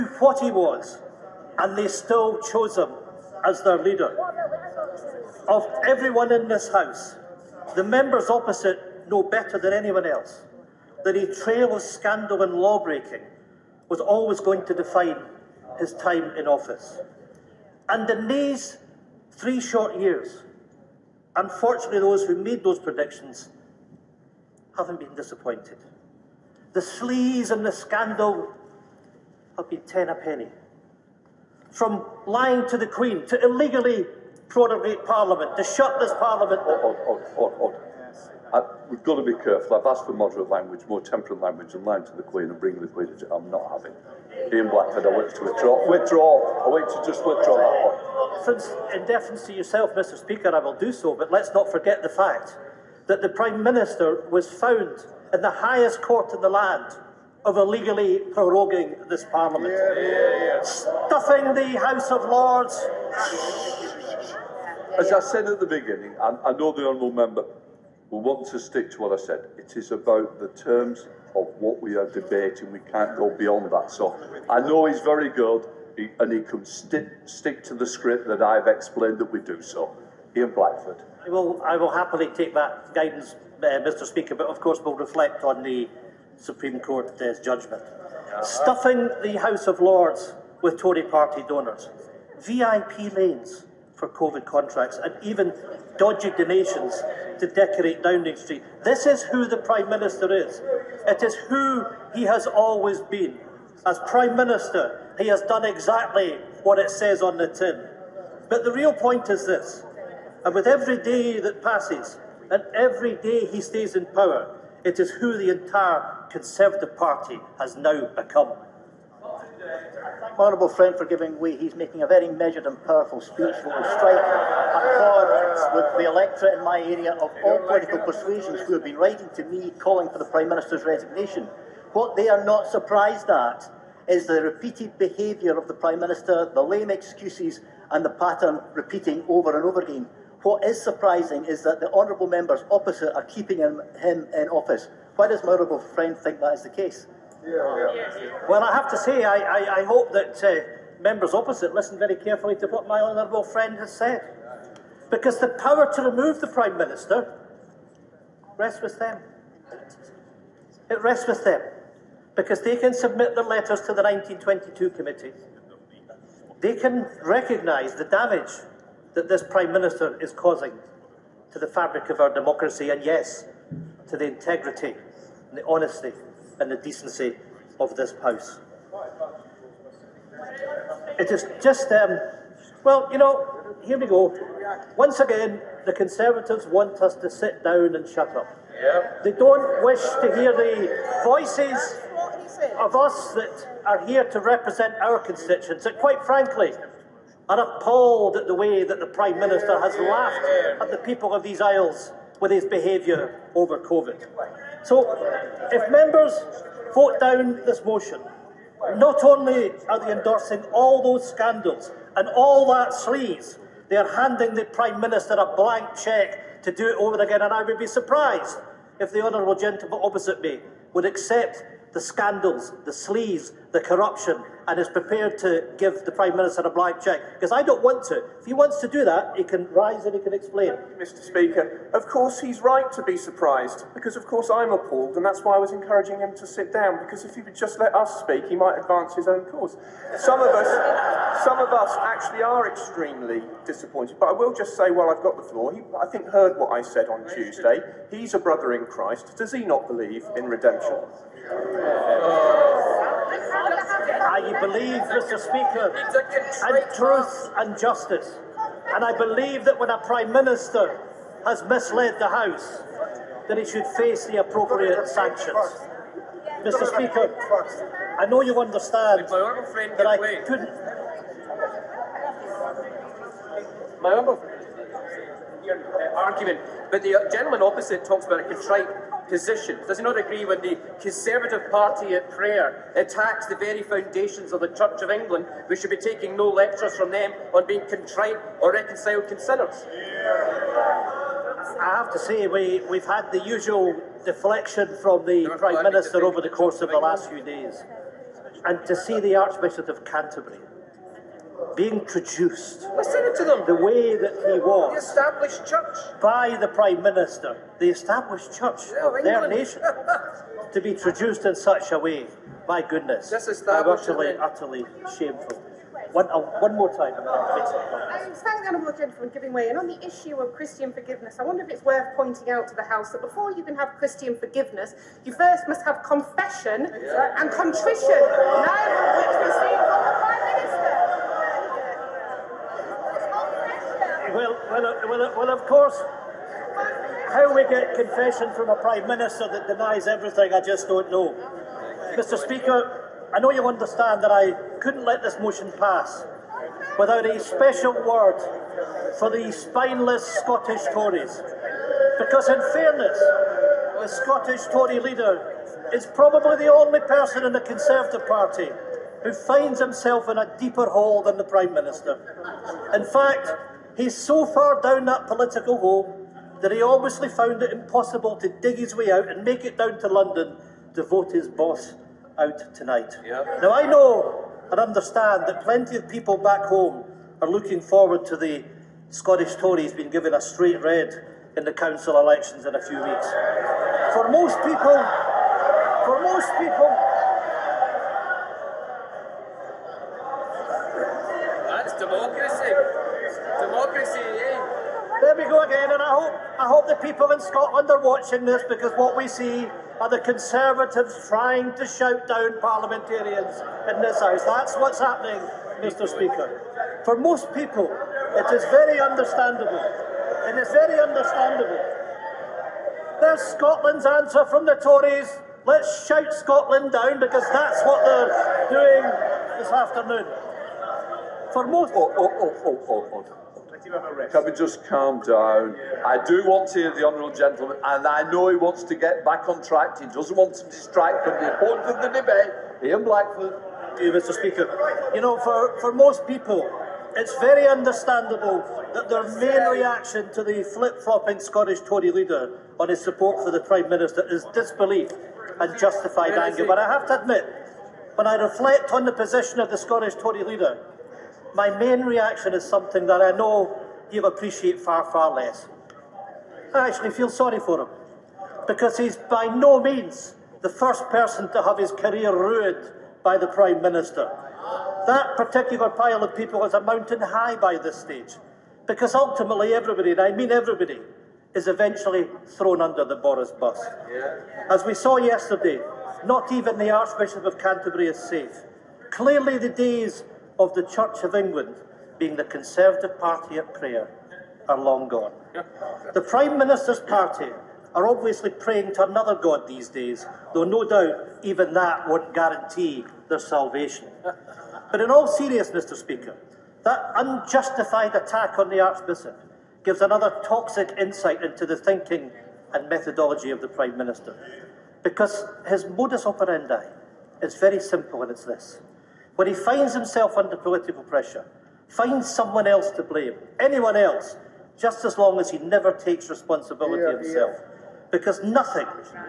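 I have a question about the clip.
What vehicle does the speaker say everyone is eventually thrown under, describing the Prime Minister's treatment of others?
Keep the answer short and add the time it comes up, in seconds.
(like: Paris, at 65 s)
the Boris bus, at 473 s.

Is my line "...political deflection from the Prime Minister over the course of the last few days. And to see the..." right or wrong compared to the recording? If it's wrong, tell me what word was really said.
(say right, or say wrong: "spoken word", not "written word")
wrong: "usual", not "political".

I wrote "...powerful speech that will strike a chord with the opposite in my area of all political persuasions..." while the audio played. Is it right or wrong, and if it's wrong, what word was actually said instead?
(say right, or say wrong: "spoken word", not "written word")
wrong: "electorate", not "opposite".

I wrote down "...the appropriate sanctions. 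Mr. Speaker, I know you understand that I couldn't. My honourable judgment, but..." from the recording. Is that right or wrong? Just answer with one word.
wrong.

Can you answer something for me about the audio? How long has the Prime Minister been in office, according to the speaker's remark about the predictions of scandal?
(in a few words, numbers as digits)
3 years.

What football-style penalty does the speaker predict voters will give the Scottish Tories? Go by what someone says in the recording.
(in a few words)
a straight red.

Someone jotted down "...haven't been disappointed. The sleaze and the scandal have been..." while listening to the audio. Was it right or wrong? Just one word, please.
right.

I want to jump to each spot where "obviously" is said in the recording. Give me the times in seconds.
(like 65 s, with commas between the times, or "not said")
366 s, 488 s.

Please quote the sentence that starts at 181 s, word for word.
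It is just, um, well, you know, here we go.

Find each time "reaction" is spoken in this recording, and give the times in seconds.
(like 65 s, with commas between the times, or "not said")
439 s, 452 s.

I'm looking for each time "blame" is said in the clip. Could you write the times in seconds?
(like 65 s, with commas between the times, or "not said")
513 s.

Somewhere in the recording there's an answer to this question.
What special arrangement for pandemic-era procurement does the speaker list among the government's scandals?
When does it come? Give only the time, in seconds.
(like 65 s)
92 s.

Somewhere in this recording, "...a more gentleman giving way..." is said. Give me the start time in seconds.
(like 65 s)
318 s.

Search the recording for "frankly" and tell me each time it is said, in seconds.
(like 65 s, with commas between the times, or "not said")
196 s.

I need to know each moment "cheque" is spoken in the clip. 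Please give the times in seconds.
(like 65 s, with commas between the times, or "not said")
216 s, 227 s.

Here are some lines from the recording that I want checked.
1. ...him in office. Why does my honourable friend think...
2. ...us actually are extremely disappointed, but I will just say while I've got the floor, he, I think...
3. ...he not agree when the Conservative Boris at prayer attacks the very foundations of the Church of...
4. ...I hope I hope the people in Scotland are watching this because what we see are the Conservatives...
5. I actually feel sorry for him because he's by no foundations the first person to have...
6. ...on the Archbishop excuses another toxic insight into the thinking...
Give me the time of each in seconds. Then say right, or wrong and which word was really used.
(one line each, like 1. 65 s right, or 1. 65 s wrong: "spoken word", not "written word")
1. 143 s right
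2. 241 s right
3. 279 s wrong: "Party", not "Boris"
4. 396 s right
5. 456 s wrong: "means", not "foundations"
6. 498 s wrong: "gives", not "excuses".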